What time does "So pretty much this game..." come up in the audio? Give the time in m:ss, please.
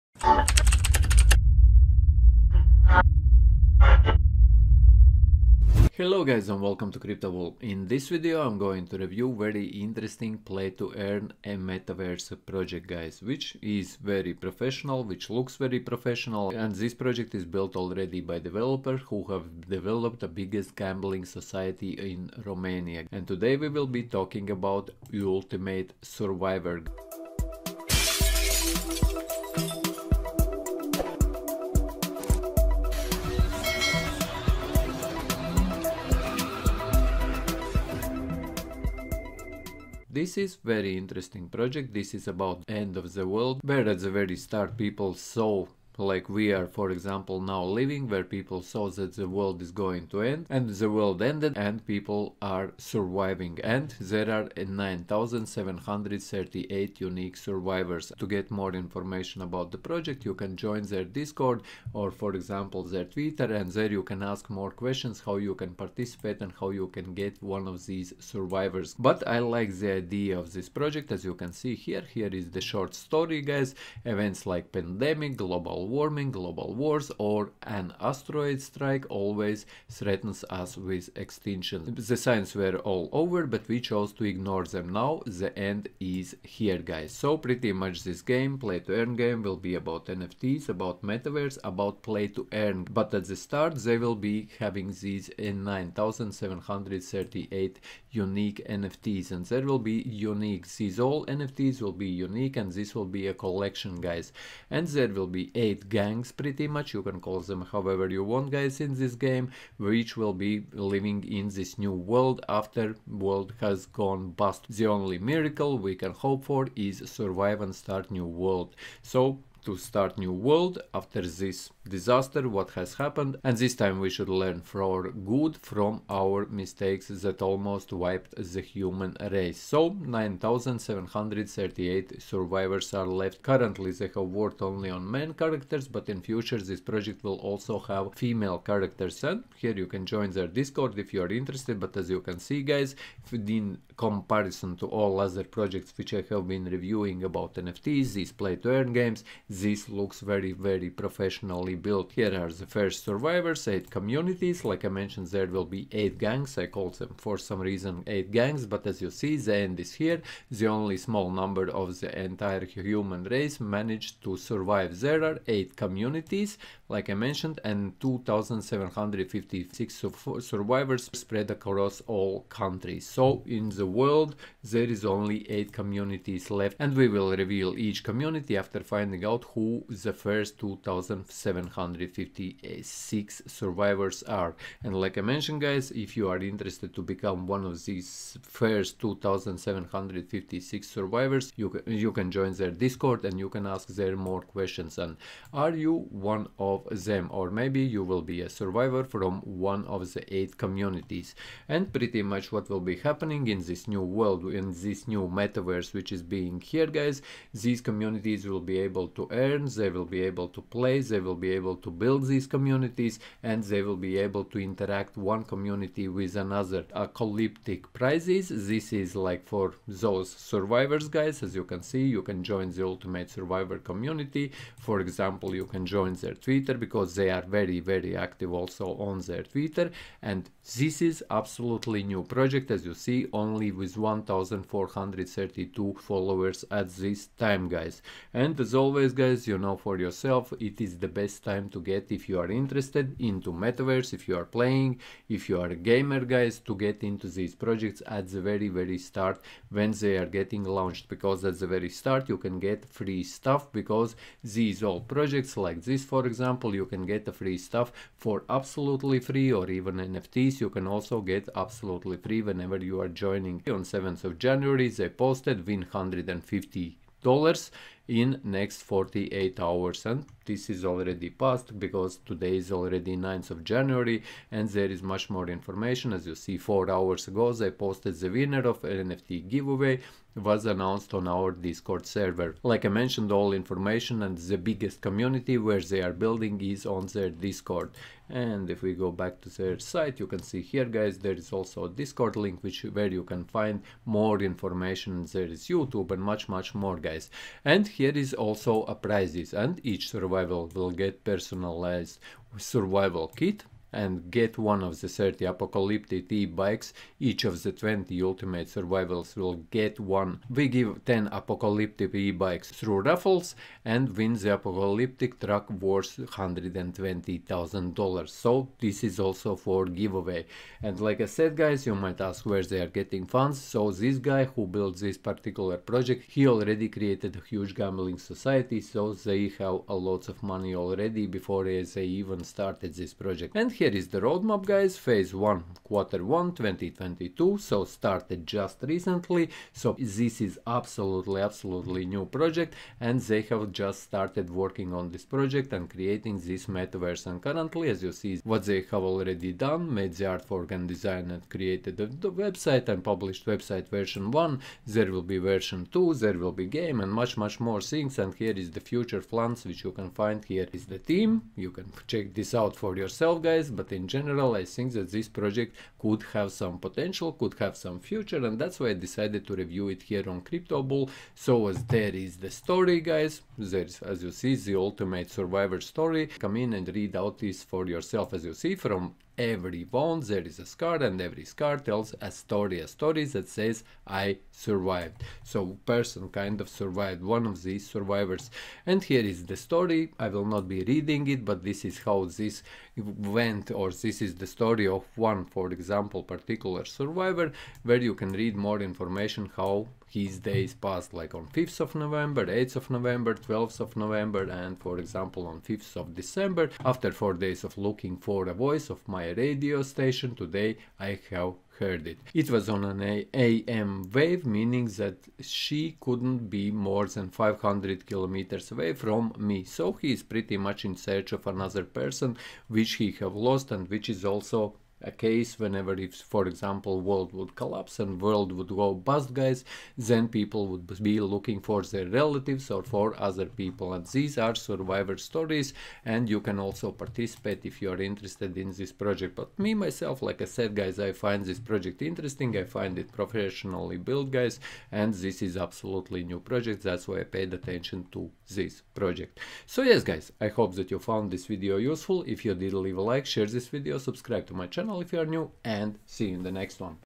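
1:27.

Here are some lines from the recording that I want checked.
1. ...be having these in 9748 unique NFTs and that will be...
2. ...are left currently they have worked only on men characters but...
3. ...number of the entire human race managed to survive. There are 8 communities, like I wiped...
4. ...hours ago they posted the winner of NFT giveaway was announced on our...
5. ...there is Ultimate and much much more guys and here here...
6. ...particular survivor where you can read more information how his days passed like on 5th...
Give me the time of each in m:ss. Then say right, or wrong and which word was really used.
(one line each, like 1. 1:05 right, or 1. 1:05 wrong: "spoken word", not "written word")
1. 1:34 wrong: "9738", not "9748"
2. 2:12 right
3. 2:41 wrong: "mentioned", not "wiped"
4. 4:36 right
5. 4:55 wrong: "YouTube", not "Ultimate"
6. 6:36 right.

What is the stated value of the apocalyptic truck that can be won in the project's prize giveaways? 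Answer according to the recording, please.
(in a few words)
$120,000.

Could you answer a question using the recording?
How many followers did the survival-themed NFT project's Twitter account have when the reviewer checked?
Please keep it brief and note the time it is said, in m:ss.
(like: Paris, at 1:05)
1,432, at 3:53.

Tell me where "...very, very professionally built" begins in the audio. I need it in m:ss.
2:30.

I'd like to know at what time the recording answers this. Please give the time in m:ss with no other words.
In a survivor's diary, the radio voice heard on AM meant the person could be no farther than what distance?
6:57.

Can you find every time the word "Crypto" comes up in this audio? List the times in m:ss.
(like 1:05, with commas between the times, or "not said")
0:06, 6:10.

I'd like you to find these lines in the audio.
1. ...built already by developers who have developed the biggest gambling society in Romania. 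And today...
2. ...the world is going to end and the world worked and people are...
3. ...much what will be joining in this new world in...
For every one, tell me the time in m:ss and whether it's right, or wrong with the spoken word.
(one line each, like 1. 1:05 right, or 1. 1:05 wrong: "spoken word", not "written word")
1. 0:17 right
2. 0:49 wrong: "ended", not "worked"
3. 3:22 wrong: "happening", not "joining".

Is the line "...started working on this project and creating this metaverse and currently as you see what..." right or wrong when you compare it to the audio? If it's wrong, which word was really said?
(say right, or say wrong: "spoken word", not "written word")
right.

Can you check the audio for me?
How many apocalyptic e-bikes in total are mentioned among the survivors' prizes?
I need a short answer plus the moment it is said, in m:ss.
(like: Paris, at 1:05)
30, at 5:05.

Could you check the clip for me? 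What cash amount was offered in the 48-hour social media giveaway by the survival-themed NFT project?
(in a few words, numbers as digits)
$150.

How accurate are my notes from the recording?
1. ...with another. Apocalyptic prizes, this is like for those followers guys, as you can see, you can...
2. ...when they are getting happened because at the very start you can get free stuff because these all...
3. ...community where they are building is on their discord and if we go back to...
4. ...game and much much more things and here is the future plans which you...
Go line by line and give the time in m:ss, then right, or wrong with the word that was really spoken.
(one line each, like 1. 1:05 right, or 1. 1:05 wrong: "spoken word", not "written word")
1. 3:36 wrong: "survivors", not "followers"
2. 4:09 wrong: "launched", not "happened"
3. 4:45 right
4. 5:56 right.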